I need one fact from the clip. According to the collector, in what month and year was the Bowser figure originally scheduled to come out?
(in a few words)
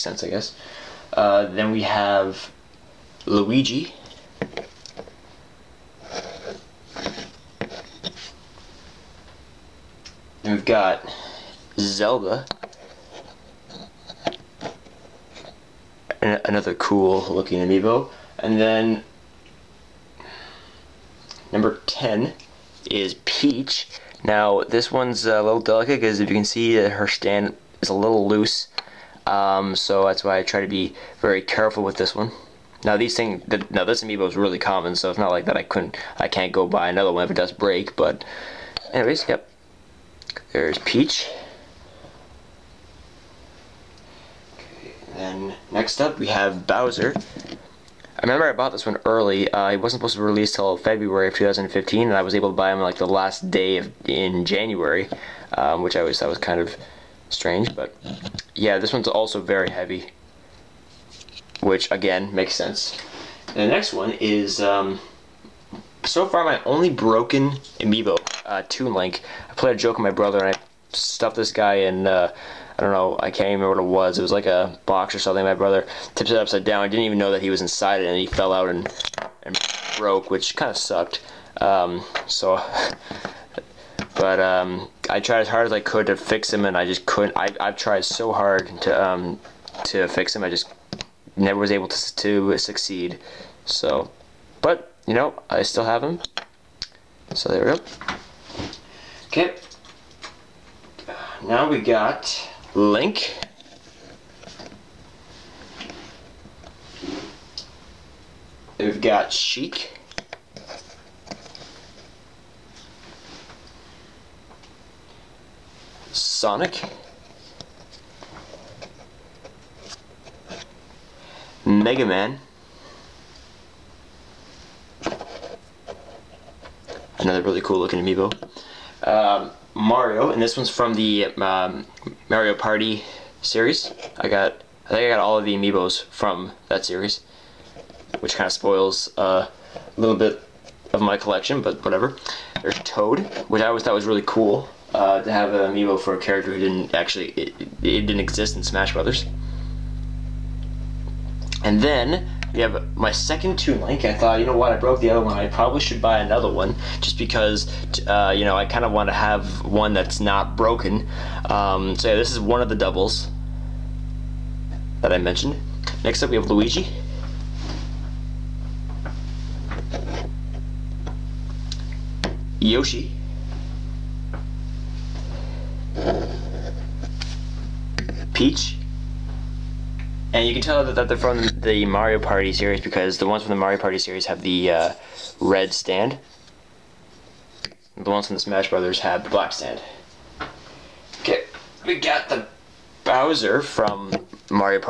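February 2015.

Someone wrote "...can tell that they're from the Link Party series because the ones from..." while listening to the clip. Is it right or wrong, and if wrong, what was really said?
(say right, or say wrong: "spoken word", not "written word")
wrong: "Mario", not "Link".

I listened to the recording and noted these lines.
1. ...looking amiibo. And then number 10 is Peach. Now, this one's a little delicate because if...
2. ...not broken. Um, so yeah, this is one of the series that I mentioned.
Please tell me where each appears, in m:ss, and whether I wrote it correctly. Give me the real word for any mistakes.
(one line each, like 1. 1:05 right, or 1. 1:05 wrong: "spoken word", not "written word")
1. 0:17 right
2. 2:40 wrong: "doubles", not "series".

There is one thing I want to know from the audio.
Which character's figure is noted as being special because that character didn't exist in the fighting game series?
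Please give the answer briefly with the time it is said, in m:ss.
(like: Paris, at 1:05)
Toad, at 2:22.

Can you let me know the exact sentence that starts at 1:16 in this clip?
I didn't even know that he was inside it, and he fell out and, and broke, which kind of sucked.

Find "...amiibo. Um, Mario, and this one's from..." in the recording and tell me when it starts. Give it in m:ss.
2:08.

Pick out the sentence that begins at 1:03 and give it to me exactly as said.
And the next one is um, so far my only broken amiibo, uh, Toon Link.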